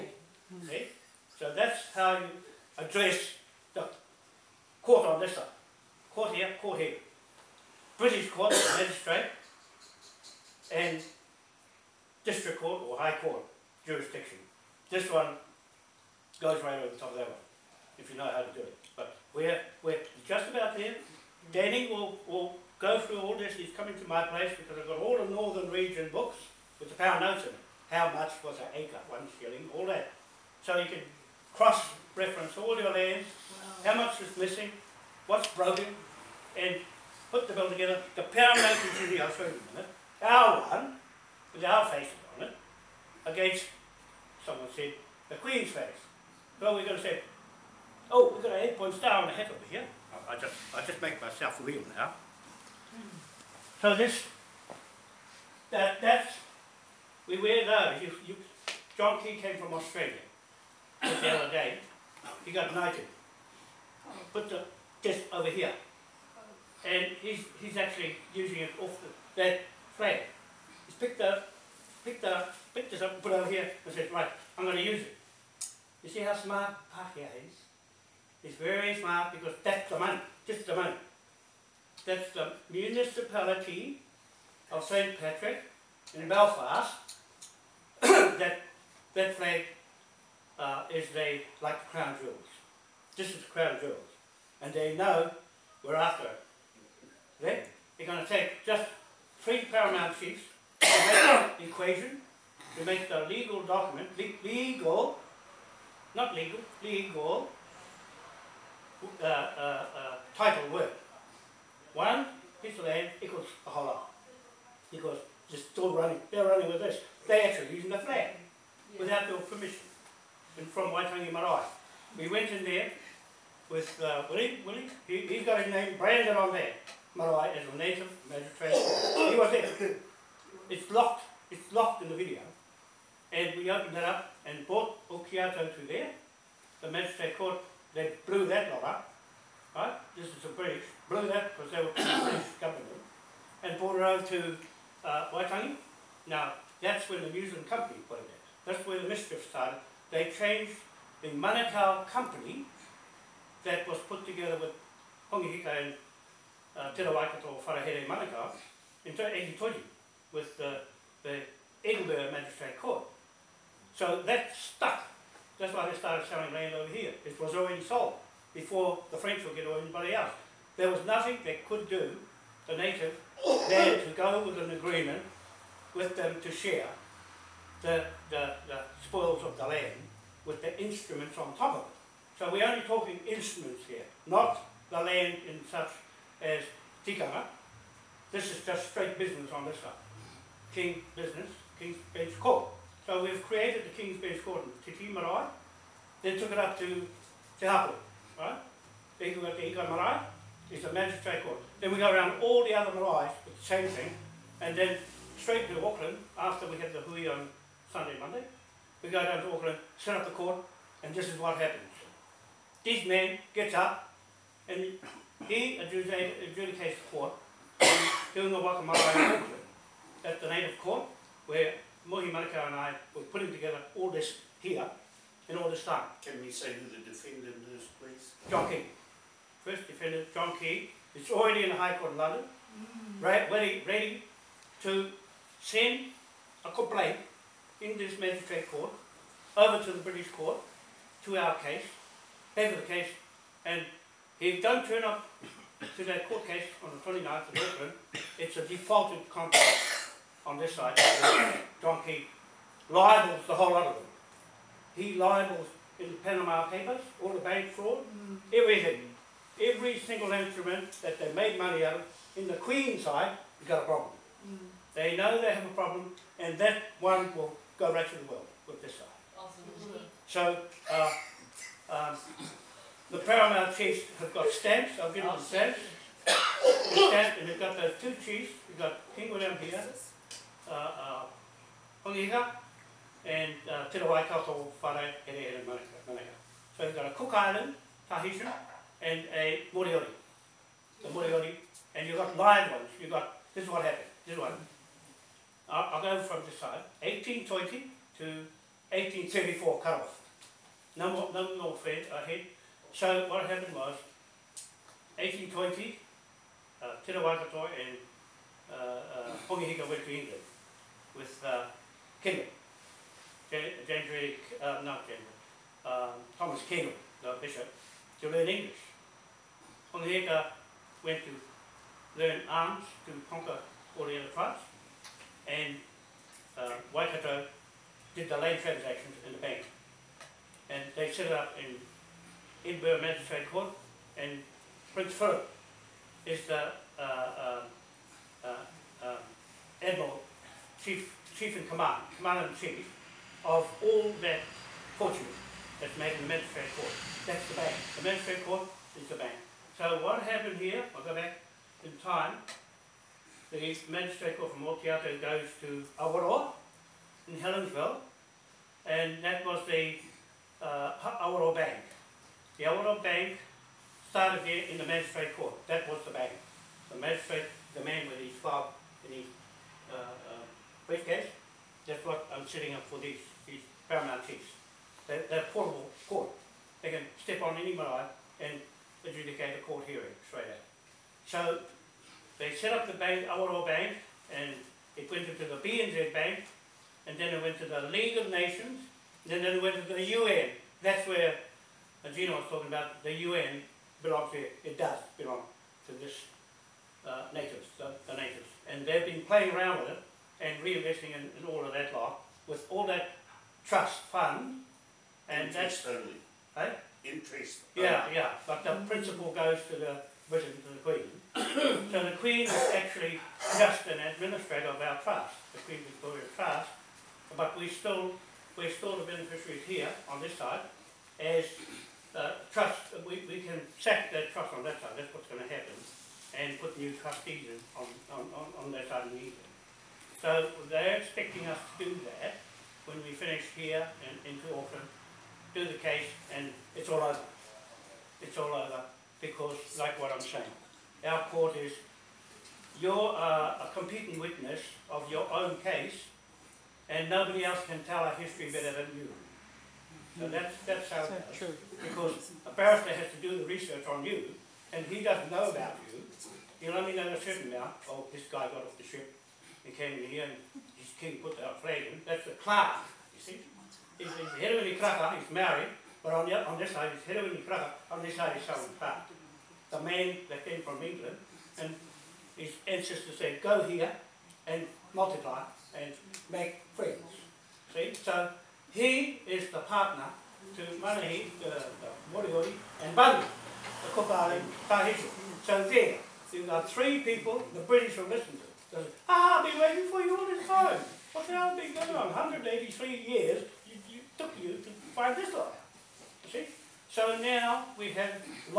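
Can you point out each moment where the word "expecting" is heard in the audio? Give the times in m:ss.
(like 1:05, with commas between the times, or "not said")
7:11.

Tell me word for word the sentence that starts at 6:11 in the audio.
That's what I'm setting up for these, these Paramount things.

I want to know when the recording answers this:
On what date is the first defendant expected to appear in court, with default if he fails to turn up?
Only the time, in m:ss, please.
4:07.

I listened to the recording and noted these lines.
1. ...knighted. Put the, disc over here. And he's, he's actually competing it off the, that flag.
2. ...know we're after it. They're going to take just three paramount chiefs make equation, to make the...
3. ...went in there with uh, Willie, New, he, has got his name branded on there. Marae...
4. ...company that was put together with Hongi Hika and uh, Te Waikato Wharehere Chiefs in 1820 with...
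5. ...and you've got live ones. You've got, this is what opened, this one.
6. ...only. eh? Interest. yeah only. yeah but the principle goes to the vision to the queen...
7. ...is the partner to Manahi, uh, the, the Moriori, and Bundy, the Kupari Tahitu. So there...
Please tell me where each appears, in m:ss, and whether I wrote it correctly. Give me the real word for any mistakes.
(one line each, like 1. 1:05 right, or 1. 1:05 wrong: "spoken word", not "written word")
1. 1:02 wrong: "using", not "competing"
2. 1:34 right
3. 2:02 wrong: "Willie", not "New"
4. 2:32 wrong: "Manukau", not "Chiefs"
5. 4:51 wrong: "happened", not "opened"
6. 6:45 right
7. 7:59 right.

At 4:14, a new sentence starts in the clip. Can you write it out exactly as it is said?
He libels in the Panama Papers, all the bank fraud, mm.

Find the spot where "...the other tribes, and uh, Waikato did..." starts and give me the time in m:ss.
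5:24.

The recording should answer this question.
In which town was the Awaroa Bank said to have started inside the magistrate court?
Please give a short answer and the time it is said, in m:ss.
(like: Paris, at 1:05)
Helensville, at 5:57.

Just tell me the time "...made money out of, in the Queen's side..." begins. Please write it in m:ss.
4:21.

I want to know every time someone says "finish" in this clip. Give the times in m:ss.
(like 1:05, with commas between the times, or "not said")
7:13.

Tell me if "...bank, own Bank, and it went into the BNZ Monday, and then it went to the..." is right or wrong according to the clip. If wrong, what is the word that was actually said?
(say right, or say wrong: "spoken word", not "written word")
wrong: "Bank", not "Monday".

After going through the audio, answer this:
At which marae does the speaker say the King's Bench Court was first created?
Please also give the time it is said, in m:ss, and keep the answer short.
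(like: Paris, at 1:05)
Te Titi Marae, at 3:14.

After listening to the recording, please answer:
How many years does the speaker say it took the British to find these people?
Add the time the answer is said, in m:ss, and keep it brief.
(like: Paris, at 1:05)
183, at 8:12.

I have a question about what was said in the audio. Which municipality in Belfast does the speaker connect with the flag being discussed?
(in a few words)
St. Patrick.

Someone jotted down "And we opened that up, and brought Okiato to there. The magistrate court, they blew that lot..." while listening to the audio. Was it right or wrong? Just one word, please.
right.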